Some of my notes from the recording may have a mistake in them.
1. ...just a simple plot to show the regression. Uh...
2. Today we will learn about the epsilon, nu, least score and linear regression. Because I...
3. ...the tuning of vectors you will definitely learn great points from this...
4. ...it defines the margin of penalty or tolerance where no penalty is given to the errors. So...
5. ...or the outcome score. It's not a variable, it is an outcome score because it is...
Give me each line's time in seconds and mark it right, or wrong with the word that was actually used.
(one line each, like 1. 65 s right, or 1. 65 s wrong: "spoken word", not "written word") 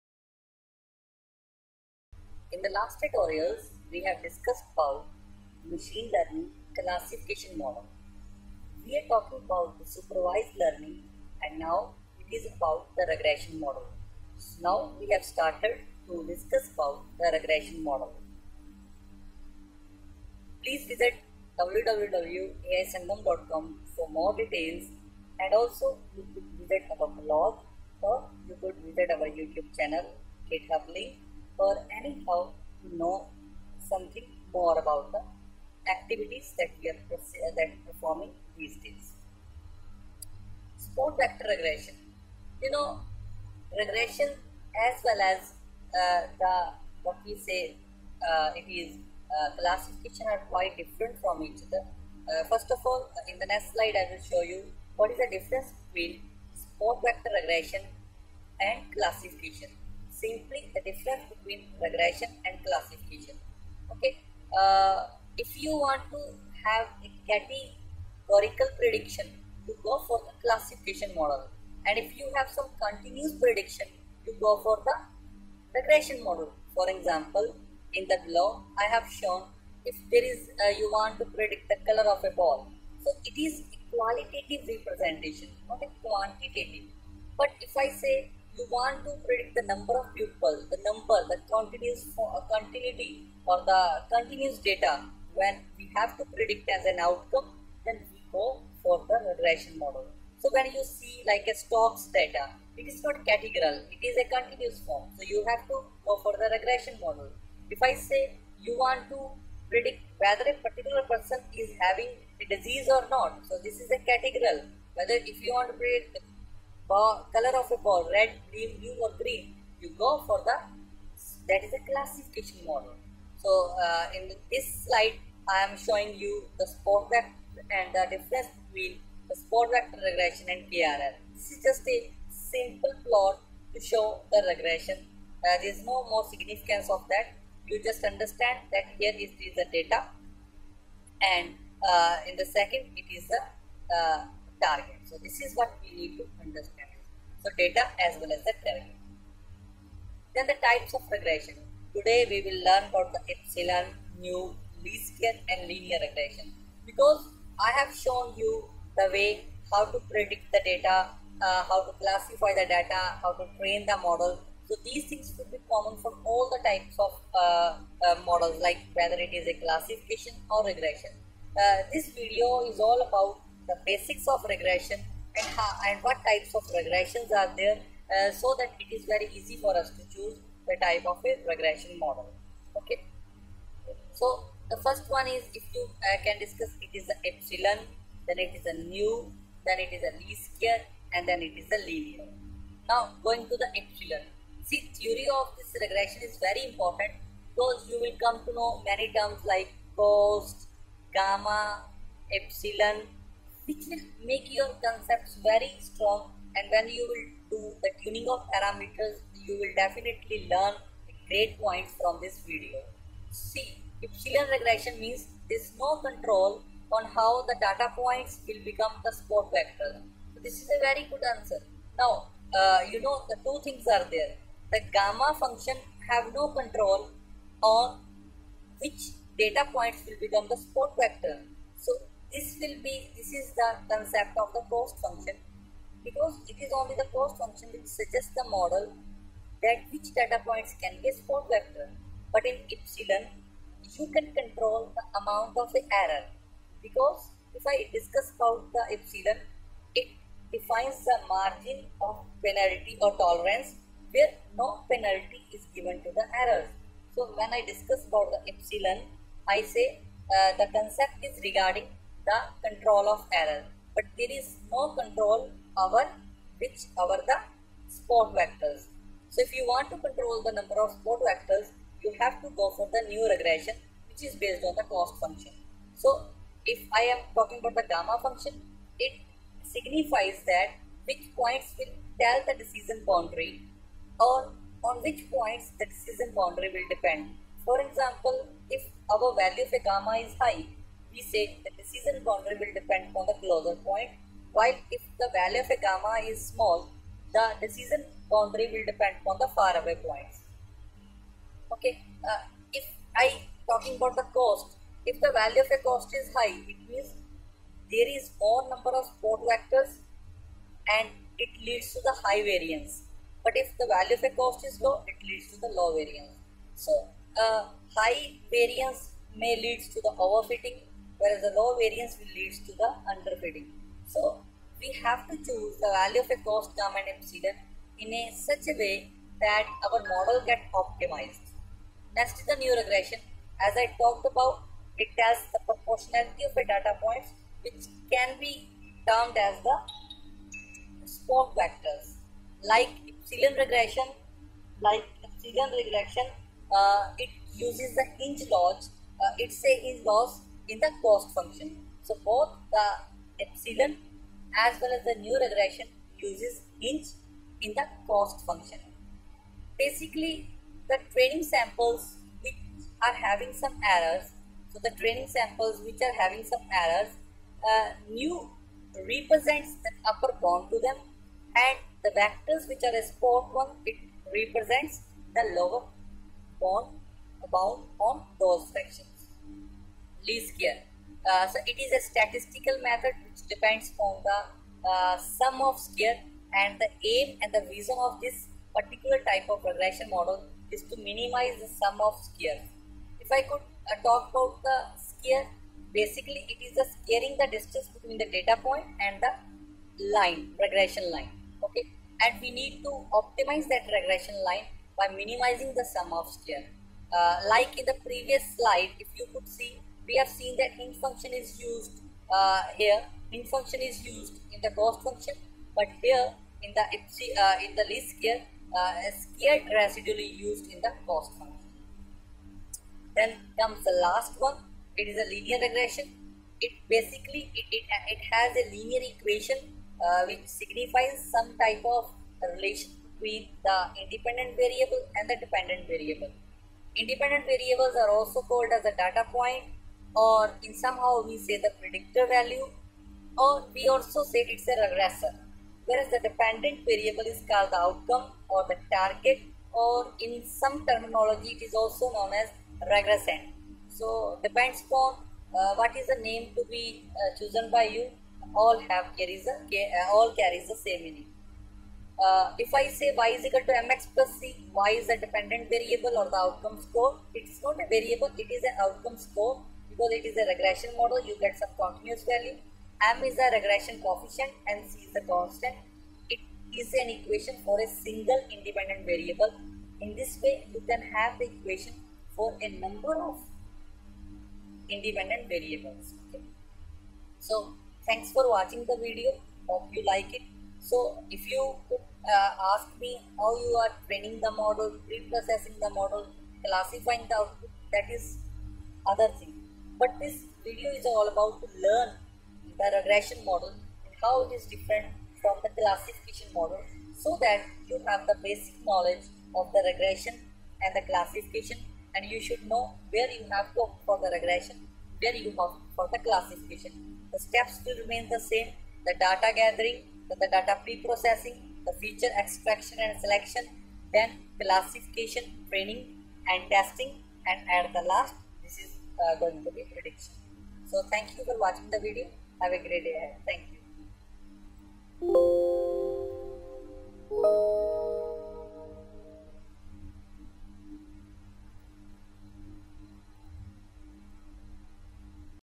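1. 131 s right
2. 151 s wrong: "square", not "score"
3. 207 s wrong: "parameters", not "vectors"
4. 249 s right
5. 466 s right.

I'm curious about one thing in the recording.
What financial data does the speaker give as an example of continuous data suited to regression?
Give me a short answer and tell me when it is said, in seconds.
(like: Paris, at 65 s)
Stocks data, at 101 s.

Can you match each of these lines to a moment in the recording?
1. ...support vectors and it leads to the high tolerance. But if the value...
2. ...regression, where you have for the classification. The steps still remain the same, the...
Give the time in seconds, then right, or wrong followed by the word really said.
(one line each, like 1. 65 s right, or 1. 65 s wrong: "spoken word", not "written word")
1. 309 s wrong: "variance", not "tolerance"
2. 514 s right.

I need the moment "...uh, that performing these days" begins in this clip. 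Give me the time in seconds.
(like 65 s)
37 s.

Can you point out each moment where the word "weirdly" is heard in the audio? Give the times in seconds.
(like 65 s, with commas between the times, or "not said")
not said.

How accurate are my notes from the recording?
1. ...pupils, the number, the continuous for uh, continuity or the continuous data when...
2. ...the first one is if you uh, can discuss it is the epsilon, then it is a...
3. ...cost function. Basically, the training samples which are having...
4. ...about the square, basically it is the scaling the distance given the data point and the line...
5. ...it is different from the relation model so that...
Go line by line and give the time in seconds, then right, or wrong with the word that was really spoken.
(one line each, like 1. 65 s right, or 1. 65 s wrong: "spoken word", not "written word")
1. 90 s right
2. 184 s right
3. 358 s right
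4. 394 s wrong: "between", not "given"
5. 504 s wrong: "classification", not "relation".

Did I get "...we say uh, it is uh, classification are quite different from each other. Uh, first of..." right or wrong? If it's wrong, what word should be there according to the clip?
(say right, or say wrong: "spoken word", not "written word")
right.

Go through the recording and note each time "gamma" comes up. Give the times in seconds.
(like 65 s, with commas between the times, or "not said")
201 s, 224 s, 277 s, 289 s, 295 s.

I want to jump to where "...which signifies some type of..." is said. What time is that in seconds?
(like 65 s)
430 s.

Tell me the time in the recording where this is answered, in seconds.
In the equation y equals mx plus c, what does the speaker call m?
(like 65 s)
473 s.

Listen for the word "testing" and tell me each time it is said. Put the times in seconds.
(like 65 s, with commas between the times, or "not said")
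526 s.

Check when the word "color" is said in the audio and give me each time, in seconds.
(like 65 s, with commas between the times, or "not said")
81 s, 117 s.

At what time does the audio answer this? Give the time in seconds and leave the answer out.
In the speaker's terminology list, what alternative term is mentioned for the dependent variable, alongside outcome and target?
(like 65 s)
452 s.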